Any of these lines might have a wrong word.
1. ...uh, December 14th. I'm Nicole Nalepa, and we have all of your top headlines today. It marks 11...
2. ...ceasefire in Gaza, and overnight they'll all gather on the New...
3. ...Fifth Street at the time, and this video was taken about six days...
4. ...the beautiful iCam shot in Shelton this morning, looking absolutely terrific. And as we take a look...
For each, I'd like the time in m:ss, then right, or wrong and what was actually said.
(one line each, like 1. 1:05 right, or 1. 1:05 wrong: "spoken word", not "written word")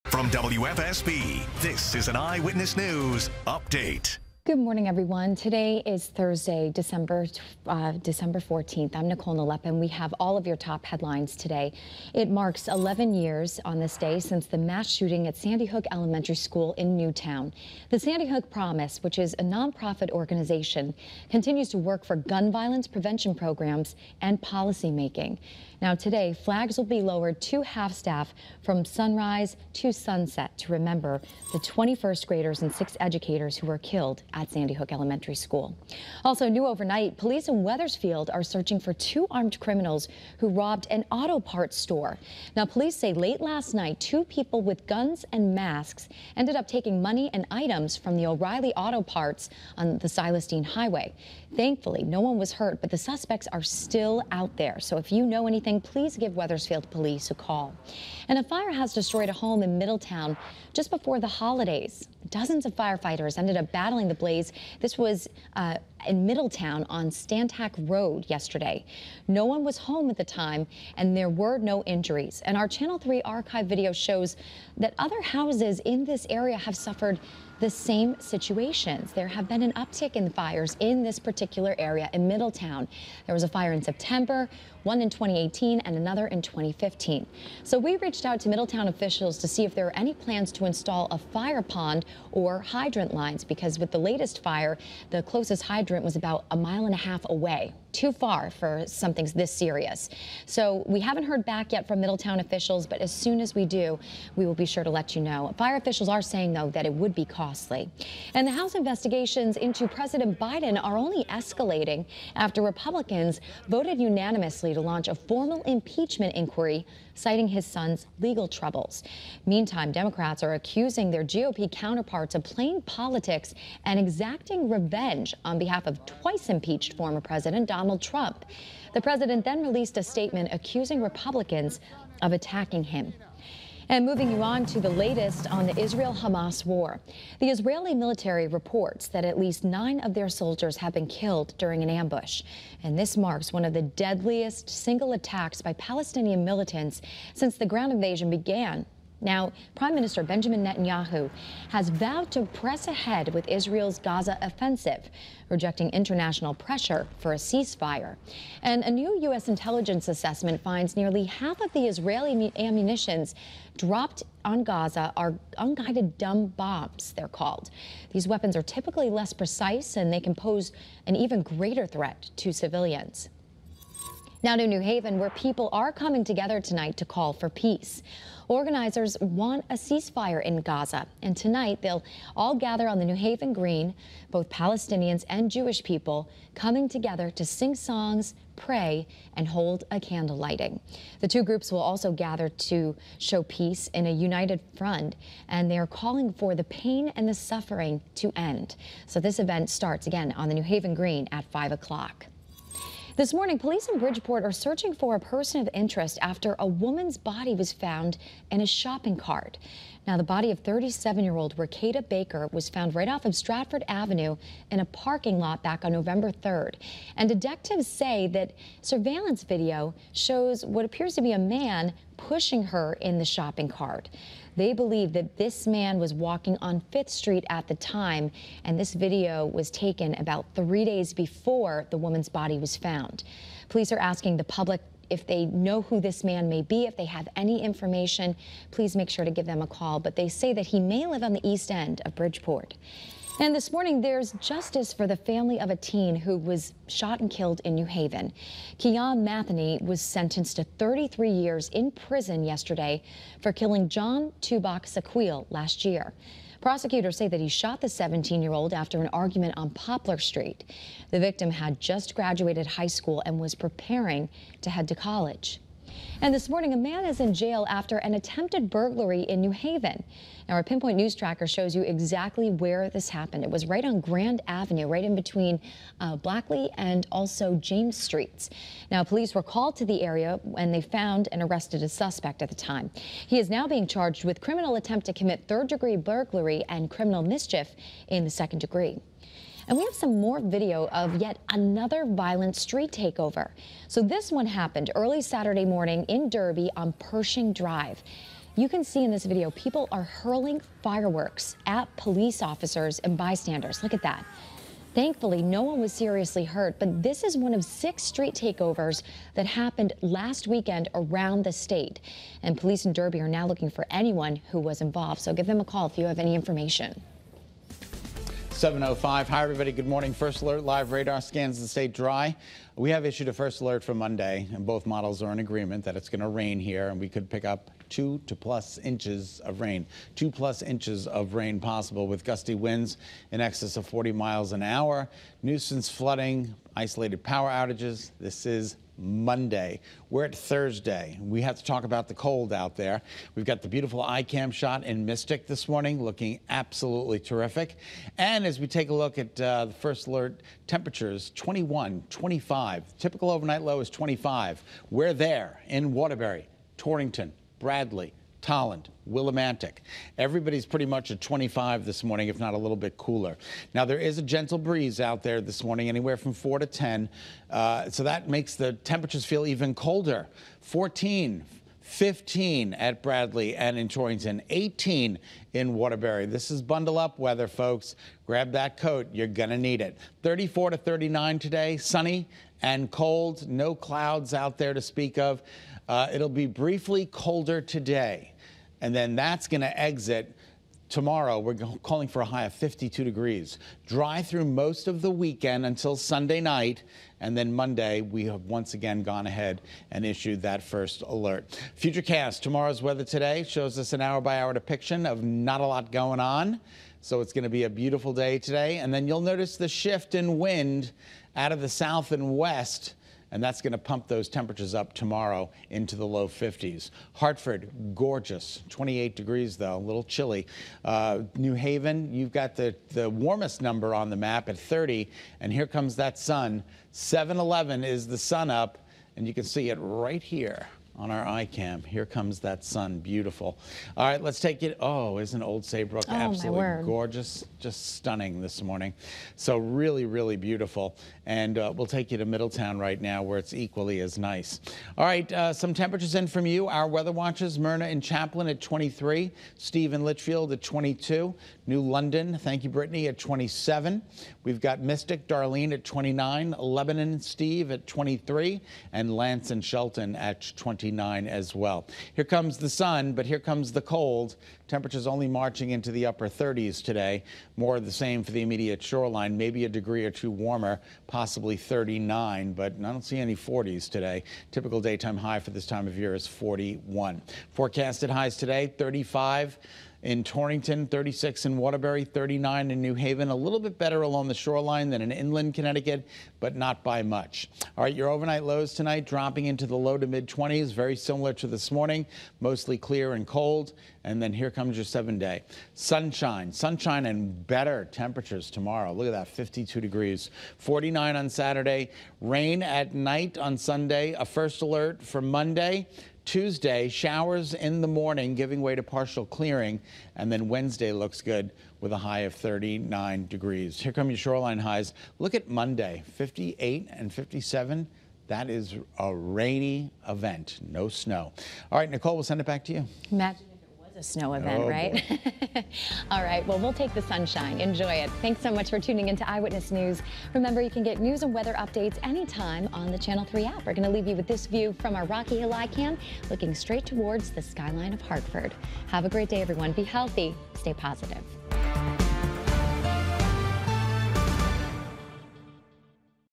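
1. 0:07 right
2. 2:59 wrong: "tonight", not "overnight"
3. 3:46 wrong: "three", not "six"
4. 5:43 wrong: "Mystic", not "Shelton".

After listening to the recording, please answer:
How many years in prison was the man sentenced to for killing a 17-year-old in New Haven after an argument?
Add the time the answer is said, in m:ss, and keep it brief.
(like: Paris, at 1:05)
33 years, at 4:10.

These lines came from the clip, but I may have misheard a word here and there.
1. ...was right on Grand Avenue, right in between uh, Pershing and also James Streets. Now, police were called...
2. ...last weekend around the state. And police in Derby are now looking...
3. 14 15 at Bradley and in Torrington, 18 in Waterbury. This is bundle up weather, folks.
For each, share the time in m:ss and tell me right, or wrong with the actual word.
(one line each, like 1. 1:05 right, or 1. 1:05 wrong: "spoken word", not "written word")
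1. 4:33 wrong: "Blatchley", not "Pershing"
2. 5:10 right
3. 6:10 right.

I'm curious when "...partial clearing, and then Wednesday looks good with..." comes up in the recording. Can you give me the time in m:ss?
8:28.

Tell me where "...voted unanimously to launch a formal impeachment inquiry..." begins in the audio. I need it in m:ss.
1:53.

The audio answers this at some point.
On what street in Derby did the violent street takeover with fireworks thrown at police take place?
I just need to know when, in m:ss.
4:56.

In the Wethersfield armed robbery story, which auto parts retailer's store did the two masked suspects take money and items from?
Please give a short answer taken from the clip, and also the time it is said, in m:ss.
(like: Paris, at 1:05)
O'Reilly Auto Parts, at 0:48.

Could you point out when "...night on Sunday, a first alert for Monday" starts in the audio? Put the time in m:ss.
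8:22.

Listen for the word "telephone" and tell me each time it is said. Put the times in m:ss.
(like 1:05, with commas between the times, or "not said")
not said.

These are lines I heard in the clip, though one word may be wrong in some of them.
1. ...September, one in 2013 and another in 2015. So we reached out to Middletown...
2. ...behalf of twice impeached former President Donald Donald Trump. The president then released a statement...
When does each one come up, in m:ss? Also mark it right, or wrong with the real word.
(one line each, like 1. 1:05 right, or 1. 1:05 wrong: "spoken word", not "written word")
1. 1:23 wrong: "2018", not "2013"
2. 2:05 right.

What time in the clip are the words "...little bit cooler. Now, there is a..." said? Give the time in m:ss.
6:02.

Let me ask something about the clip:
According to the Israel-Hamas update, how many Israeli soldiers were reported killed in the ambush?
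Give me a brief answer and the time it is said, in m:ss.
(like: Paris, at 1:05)
9, at 2:19.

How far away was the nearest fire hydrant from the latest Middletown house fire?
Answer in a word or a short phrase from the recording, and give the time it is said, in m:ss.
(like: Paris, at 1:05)
a mile and a half, at 1:36.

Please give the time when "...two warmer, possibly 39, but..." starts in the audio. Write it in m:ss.
7:50.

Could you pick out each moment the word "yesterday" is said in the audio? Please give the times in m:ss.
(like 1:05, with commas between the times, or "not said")
1:08, 4:12.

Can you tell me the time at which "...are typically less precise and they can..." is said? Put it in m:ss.
2:48.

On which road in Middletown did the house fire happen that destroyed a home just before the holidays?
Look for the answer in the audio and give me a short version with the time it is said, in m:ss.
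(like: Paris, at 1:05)
Stantac Road, at 1:07.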